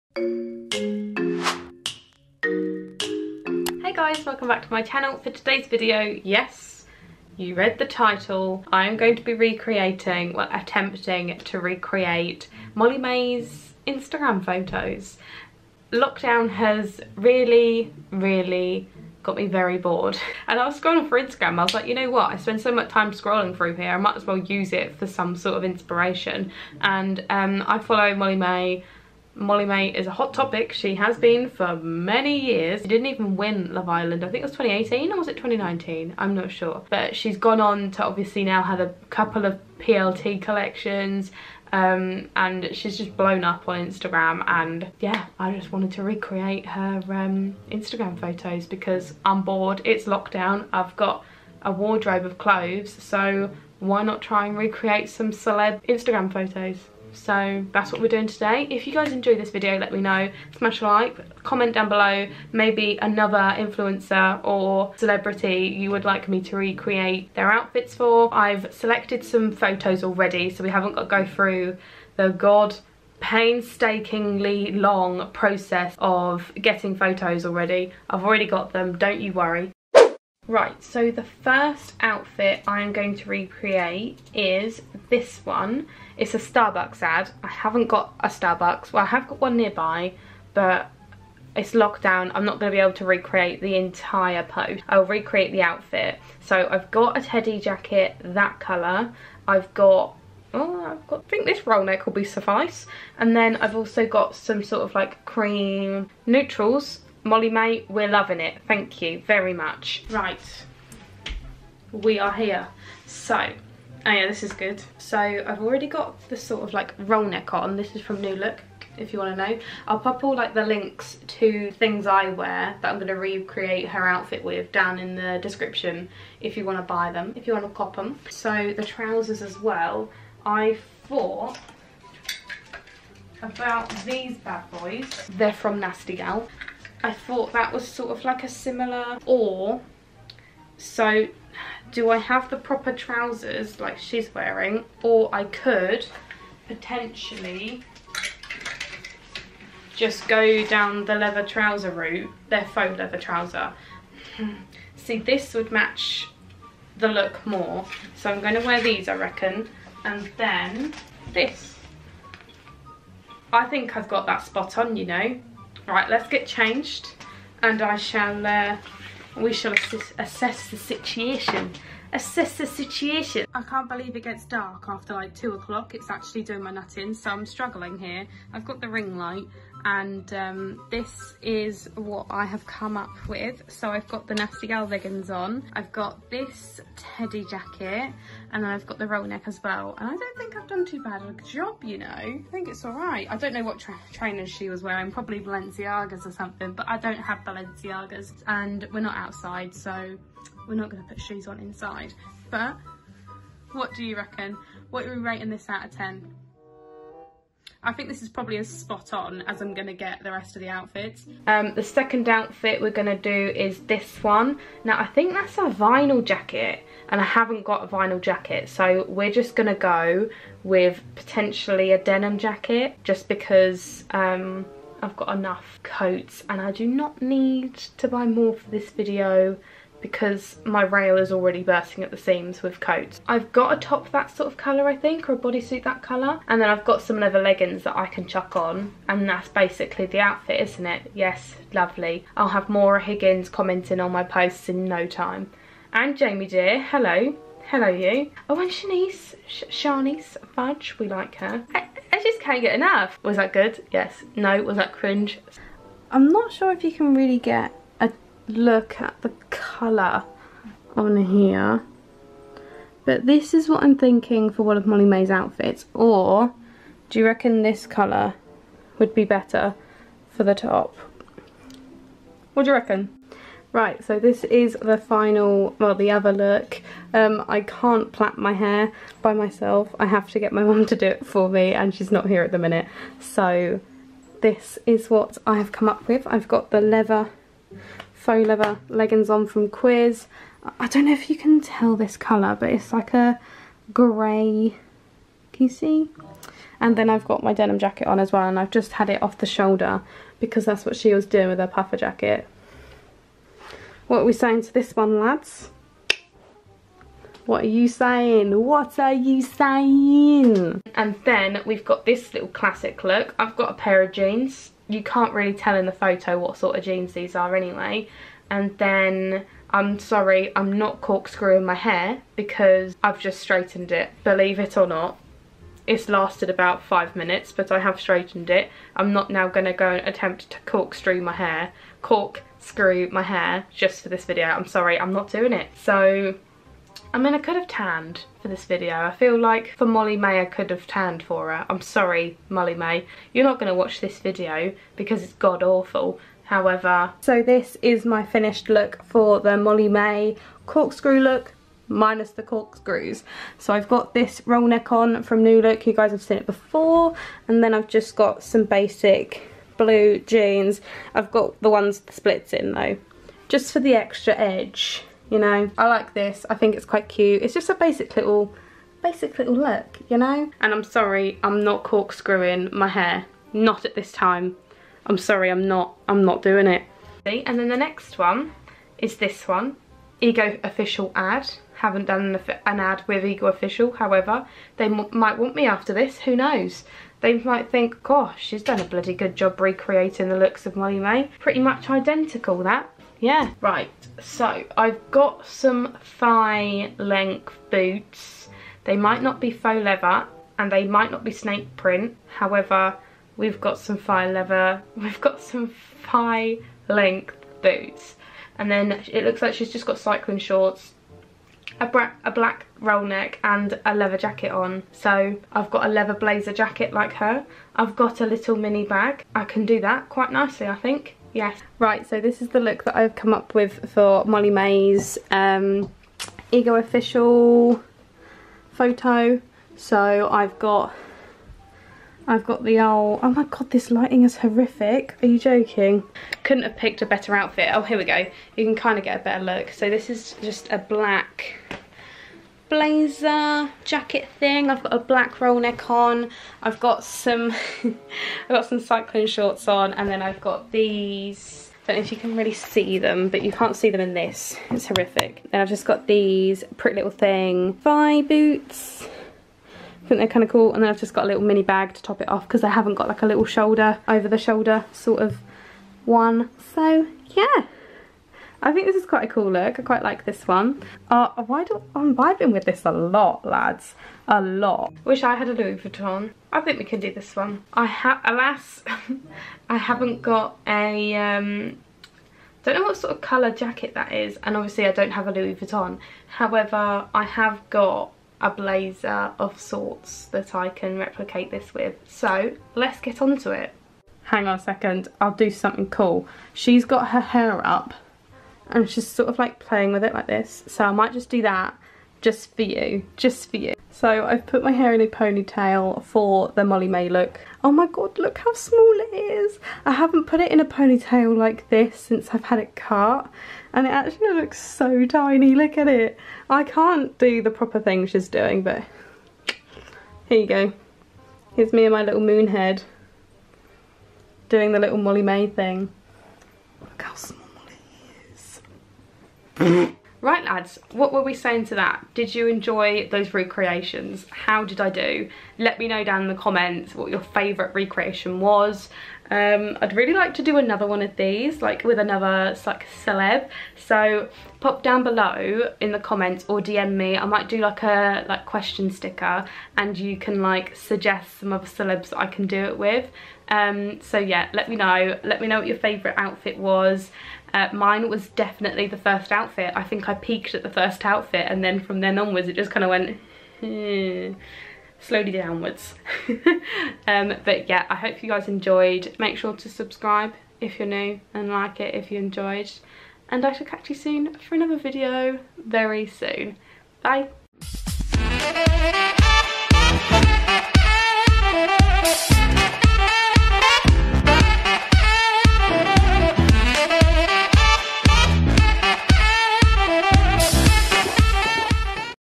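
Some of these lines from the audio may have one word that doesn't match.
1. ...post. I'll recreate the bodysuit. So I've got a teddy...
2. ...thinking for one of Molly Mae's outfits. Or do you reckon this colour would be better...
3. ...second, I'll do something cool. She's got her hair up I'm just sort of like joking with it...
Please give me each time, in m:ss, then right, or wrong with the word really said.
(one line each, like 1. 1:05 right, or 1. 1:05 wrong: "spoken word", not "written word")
1. 1:34 wrong: "outfit", not "bodysuit"
2. 4:23 right
3. 8:14 wrong: "playing", not "joking".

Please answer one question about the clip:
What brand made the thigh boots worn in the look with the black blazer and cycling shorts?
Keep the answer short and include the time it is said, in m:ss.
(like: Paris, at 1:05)
Pretty Little Thing, at 7:36.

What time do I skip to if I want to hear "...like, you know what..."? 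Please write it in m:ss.
0:21.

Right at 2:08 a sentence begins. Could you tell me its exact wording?
So the trousers as well, I thought about these bad boys.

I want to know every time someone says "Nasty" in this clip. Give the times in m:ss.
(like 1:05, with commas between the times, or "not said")
2:15, 3:04.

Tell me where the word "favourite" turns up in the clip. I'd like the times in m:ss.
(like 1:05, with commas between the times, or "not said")
8:57, 9:15.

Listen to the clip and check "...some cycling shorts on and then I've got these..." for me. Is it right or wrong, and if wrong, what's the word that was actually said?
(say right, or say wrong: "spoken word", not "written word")
right.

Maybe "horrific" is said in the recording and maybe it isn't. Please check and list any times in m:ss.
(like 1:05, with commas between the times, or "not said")
7:14, 7:34.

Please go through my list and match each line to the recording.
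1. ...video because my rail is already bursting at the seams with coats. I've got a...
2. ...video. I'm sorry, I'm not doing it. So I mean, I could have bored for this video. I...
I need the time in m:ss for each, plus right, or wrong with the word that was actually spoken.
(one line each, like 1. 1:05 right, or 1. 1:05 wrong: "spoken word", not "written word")
1. 3:48 right
2. 5:34 wrong: "tanned", not "bored".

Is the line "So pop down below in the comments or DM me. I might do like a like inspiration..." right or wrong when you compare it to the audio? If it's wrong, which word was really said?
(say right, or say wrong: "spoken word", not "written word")
wrong: "question", not "inspiration".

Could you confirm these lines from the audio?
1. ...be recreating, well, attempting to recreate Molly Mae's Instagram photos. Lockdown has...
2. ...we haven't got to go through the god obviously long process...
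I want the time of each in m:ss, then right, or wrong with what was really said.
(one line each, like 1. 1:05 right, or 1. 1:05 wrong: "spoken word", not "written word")
1. 0:09 right
2. 1:10 wrong: "painstakingly", not "obviously".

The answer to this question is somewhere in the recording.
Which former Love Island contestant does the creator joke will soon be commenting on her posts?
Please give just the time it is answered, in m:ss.
4:02.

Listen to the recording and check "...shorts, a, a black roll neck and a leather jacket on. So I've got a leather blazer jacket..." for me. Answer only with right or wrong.
right.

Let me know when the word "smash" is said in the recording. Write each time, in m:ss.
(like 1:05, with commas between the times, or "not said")
1:00.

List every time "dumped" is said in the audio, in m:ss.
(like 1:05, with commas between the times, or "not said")
not said.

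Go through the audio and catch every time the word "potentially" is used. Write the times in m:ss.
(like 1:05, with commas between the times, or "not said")
2:26, 3:41.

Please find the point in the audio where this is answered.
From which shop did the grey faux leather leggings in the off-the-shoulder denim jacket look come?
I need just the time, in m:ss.
4:49.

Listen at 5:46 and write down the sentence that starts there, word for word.
However, so this is my finished look for the Molly Mae corkscrew look minus the corkscrews.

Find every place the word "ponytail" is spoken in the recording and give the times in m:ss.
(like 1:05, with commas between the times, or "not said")
8:25, 8:30.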